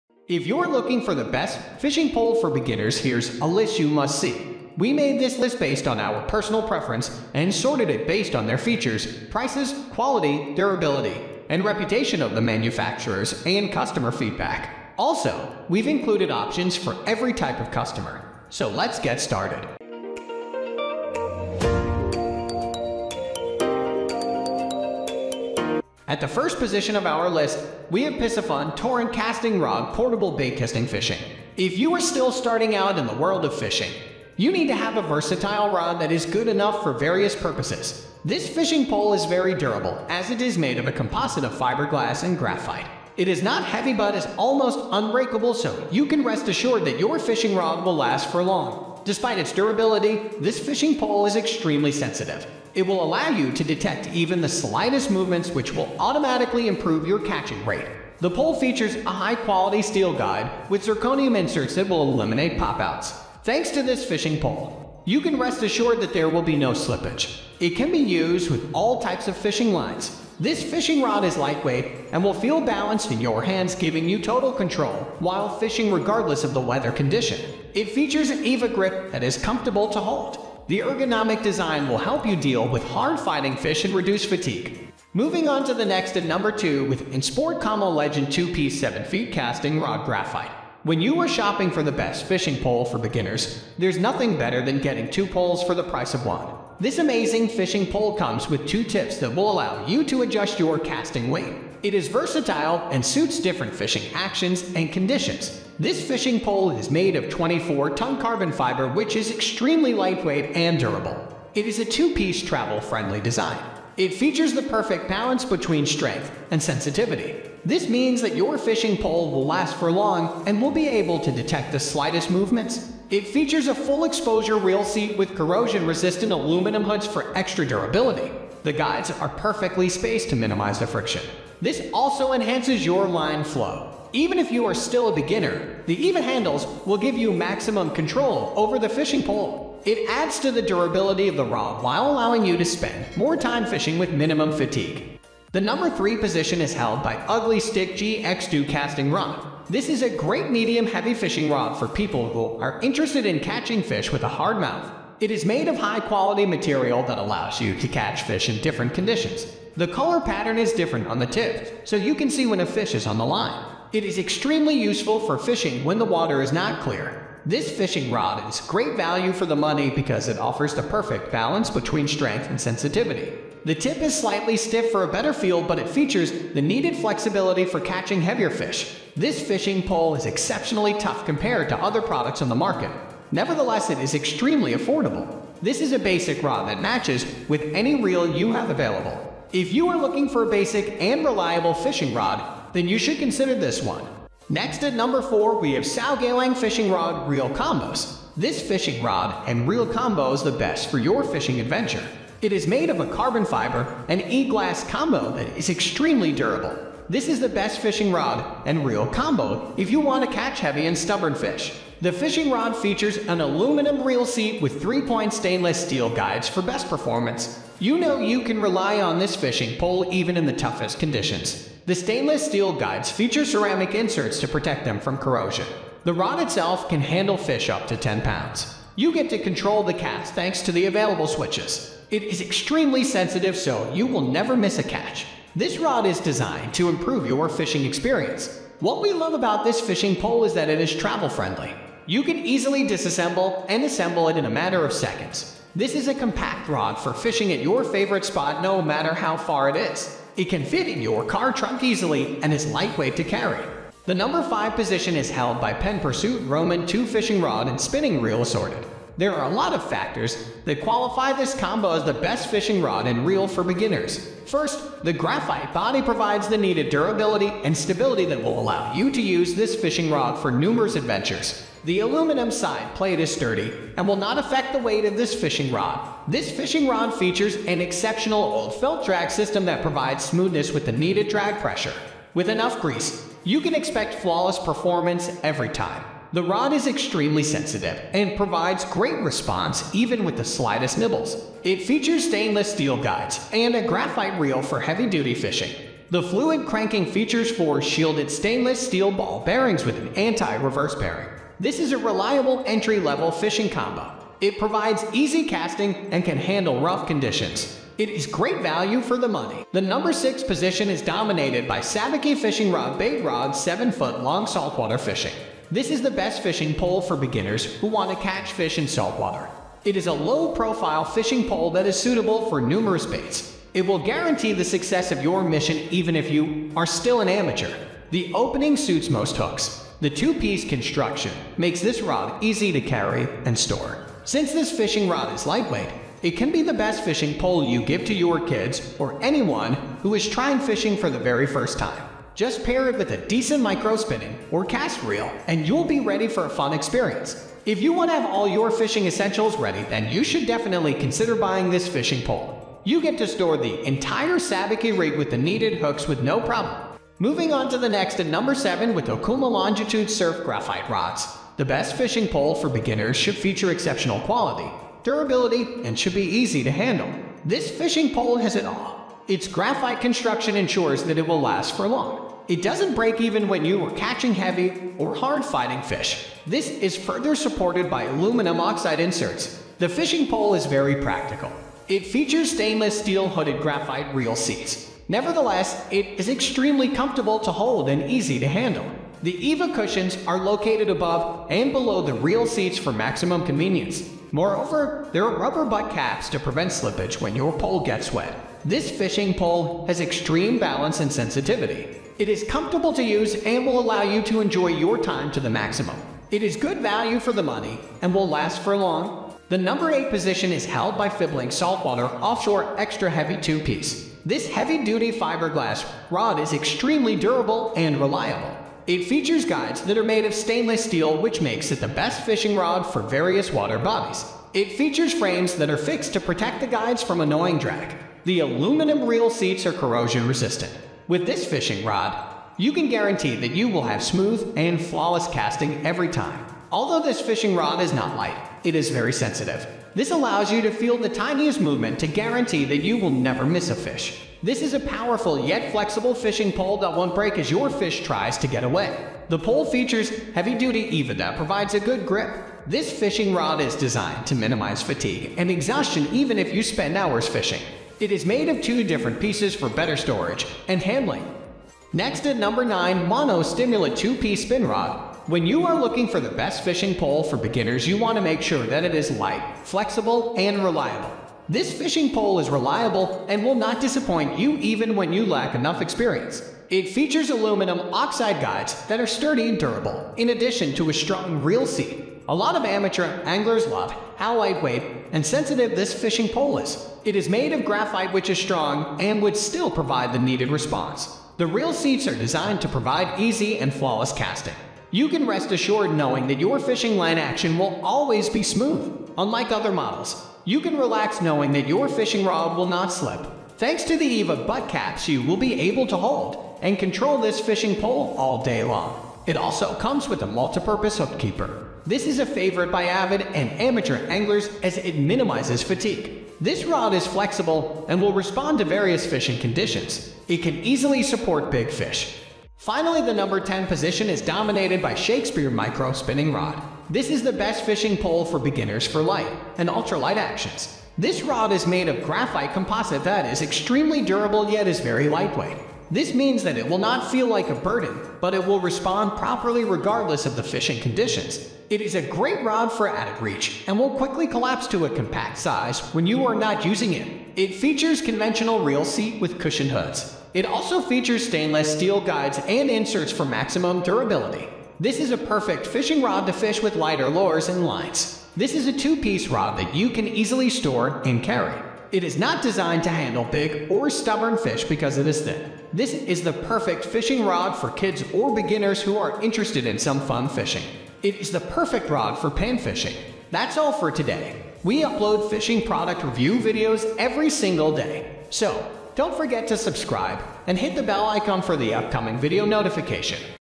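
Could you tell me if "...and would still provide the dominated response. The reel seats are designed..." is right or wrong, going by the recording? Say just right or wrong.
wrong.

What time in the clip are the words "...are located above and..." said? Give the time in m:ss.
6:30.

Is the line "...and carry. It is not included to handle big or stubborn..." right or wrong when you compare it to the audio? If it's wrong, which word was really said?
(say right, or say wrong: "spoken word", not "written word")
wrong: "designed", not "included".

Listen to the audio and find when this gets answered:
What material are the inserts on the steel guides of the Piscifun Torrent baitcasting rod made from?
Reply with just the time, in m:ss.
1:00.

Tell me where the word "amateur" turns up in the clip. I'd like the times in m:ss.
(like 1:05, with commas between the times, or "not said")
5:27, 8:02, 8:33.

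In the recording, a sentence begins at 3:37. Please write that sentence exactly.
You know you can rely on this fishing pole even in the toughest conditions.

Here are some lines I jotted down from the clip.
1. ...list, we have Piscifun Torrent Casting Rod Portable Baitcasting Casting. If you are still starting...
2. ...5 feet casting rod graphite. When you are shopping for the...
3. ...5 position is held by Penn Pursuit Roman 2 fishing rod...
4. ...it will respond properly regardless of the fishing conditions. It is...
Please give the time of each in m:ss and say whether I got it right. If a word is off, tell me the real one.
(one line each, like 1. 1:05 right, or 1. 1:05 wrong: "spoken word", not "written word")
1. 0:27 wrong: "Fishing", not "Casting"
2. 1:28 wrong: "7", not "5"
3. 4:14 right
4. 8:58 right.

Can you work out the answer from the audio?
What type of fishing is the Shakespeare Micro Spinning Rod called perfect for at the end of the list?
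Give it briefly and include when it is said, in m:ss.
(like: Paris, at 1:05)
Pan fishing, at 9:32.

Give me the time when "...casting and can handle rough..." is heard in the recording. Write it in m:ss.
5:05.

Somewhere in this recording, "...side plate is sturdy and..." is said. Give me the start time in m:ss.
4:32.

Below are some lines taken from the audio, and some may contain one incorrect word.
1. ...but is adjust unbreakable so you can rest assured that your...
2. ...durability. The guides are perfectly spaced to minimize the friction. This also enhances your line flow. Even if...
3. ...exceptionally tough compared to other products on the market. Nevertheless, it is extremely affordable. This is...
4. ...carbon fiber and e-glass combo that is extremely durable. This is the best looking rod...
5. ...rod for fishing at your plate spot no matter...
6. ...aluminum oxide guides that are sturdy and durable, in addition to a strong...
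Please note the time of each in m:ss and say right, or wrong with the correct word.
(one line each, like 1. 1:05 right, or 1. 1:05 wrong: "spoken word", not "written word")
1. 0:43 wrong: "almost", not "adjust"
2. 2:07 right
3. 3:00 right
4. 3:23 wrong: "fishing", not "looking"
5. 4:06 wrong: "favorite", not "plate"
6. 7:57 right.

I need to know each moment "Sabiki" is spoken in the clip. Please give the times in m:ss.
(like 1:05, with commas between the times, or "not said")
5:11, 5:54.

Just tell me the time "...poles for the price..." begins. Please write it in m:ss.
1:35.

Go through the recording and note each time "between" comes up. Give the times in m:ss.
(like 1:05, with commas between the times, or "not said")
1:55, 2:51.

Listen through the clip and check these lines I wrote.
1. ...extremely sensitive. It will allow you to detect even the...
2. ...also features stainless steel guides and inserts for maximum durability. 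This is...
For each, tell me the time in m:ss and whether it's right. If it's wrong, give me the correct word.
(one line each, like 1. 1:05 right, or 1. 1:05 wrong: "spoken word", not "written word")
1. 0:51 right
2. 9:10 right.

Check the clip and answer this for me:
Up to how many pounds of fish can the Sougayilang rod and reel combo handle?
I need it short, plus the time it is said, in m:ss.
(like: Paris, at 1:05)
10 pounds, at 3:47.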